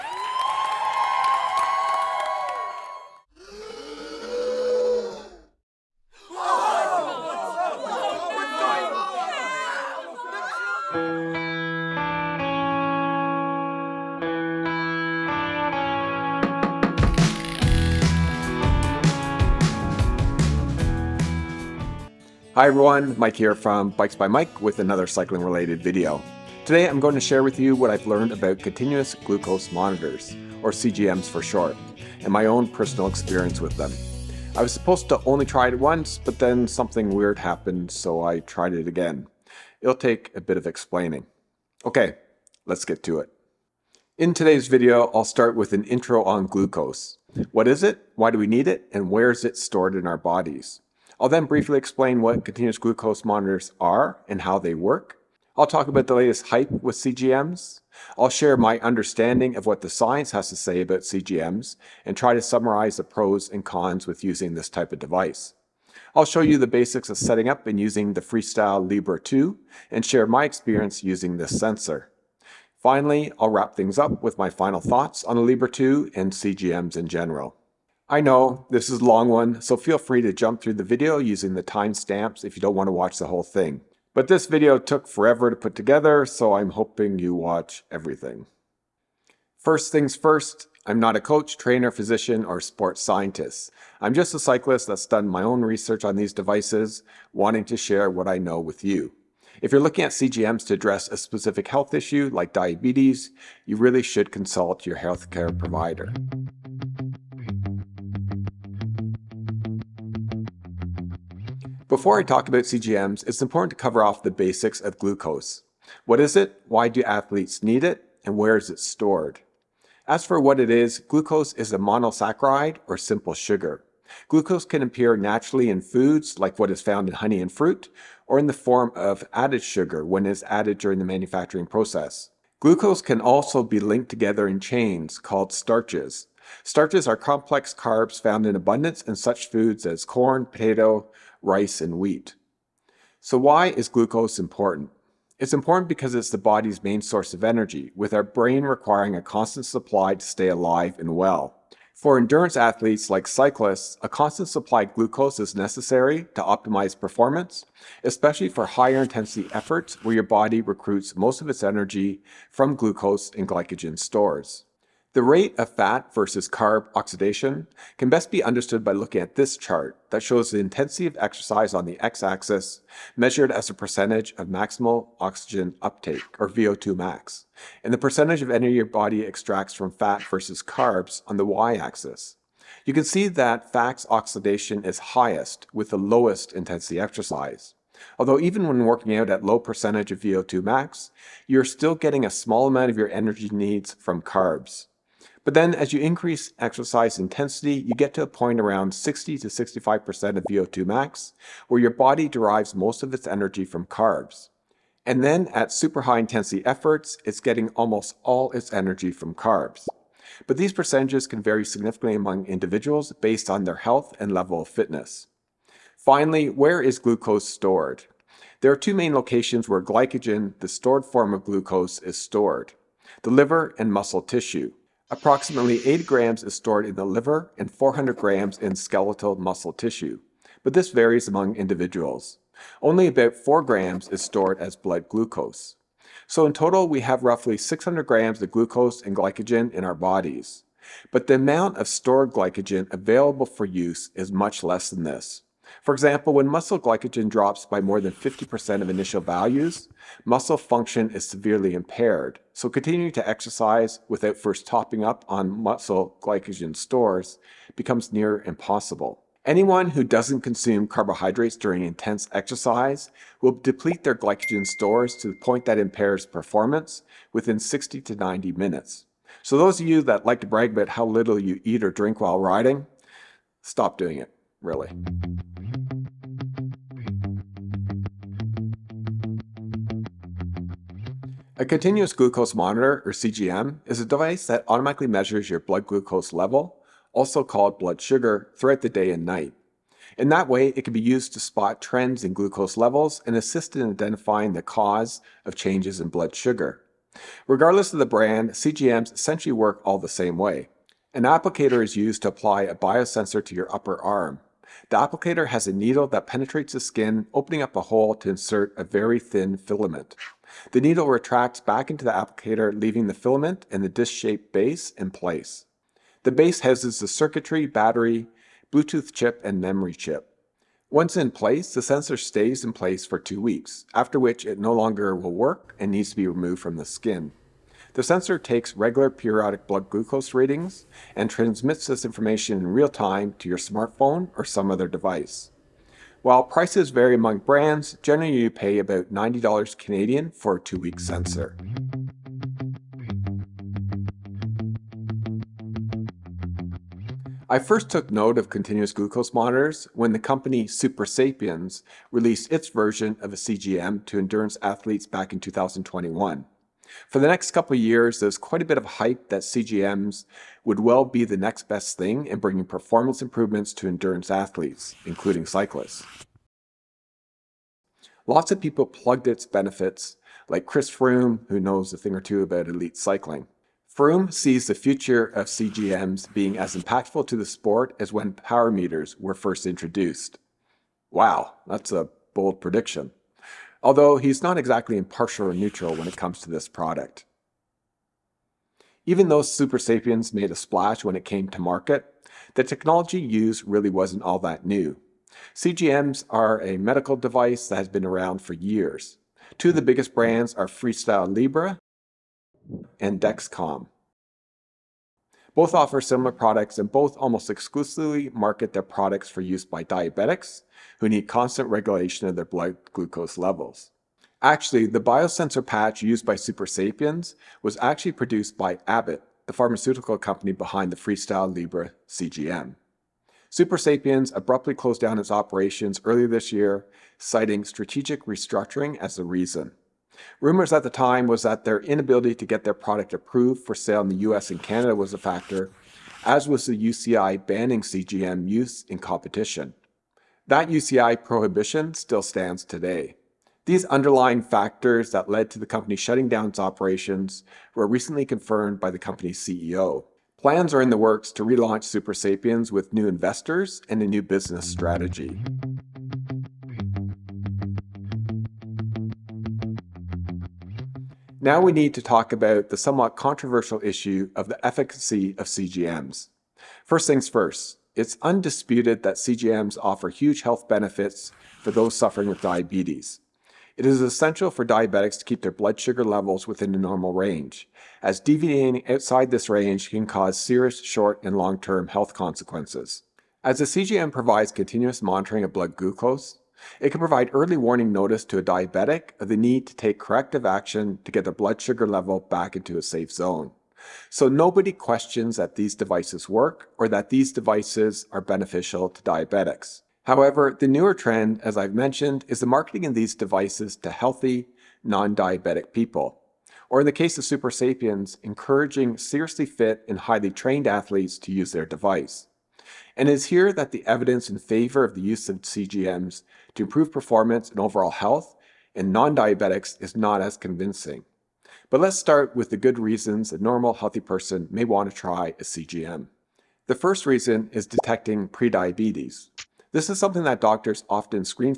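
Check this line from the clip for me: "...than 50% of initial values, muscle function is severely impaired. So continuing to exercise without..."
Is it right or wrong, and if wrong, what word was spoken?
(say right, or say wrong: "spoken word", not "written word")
right.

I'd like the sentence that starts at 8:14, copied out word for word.
So nobody questions that these devices work or that these devices are beneficial to diabetics.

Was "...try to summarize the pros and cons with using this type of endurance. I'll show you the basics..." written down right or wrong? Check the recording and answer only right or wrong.
wrong.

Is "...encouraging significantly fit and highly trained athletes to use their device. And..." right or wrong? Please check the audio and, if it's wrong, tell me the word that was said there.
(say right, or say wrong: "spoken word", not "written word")
wrong: "seriously", not "significantly".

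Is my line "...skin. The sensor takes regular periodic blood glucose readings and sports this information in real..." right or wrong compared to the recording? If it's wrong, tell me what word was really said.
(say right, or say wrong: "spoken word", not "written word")
wrong: "transmits", not "sports".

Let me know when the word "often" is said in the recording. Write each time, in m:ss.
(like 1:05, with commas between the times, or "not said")
8:50.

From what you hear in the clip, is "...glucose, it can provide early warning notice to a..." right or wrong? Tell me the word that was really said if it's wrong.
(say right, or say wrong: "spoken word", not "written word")
right.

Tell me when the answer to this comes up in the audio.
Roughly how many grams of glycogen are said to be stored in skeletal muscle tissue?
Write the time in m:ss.
3:47.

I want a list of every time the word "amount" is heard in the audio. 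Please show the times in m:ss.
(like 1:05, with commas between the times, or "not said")
3:12, 4:01.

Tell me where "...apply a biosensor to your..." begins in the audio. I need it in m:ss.
5:02.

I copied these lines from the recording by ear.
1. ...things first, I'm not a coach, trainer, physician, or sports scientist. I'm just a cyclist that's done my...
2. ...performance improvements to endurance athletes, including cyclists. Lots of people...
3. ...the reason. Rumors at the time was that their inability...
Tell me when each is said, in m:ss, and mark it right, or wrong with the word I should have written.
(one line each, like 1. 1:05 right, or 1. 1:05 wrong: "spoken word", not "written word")
1. 1:29 right
2. 6:02 right
3. 7:09 right.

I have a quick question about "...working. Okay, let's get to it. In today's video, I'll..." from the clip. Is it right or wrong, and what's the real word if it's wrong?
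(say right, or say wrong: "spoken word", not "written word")
wrong: "explaining", not "working".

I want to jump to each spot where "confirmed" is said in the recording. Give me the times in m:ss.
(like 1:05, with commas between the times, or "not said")
7:28.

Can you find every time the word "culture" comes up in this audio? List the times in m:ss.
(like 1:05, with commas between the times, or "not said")
not said.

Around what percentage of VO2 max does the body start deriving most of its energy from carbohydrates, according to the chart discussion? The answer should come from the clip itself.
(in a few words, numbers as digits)
60 to 65%.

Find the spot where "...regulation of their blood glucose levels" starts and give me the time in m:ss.
6:51.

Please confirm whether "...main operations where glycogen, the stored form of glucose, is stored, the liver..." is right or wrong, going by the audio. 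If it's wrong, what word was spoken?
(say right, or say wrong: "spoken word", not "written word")
wrong: "locations", not "operations".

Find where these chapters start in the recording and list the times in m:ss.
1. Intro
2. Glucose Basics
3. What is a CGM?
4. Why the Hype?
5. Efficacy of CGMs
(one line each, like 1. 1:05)
1. 0:22
2. 1:47
3. 4:35
4. 5:41
5. 7:35.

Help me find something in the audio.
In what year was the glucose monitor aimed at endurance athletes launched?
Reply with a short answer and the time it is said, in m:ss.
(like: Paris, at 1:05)
2021, at 5:55.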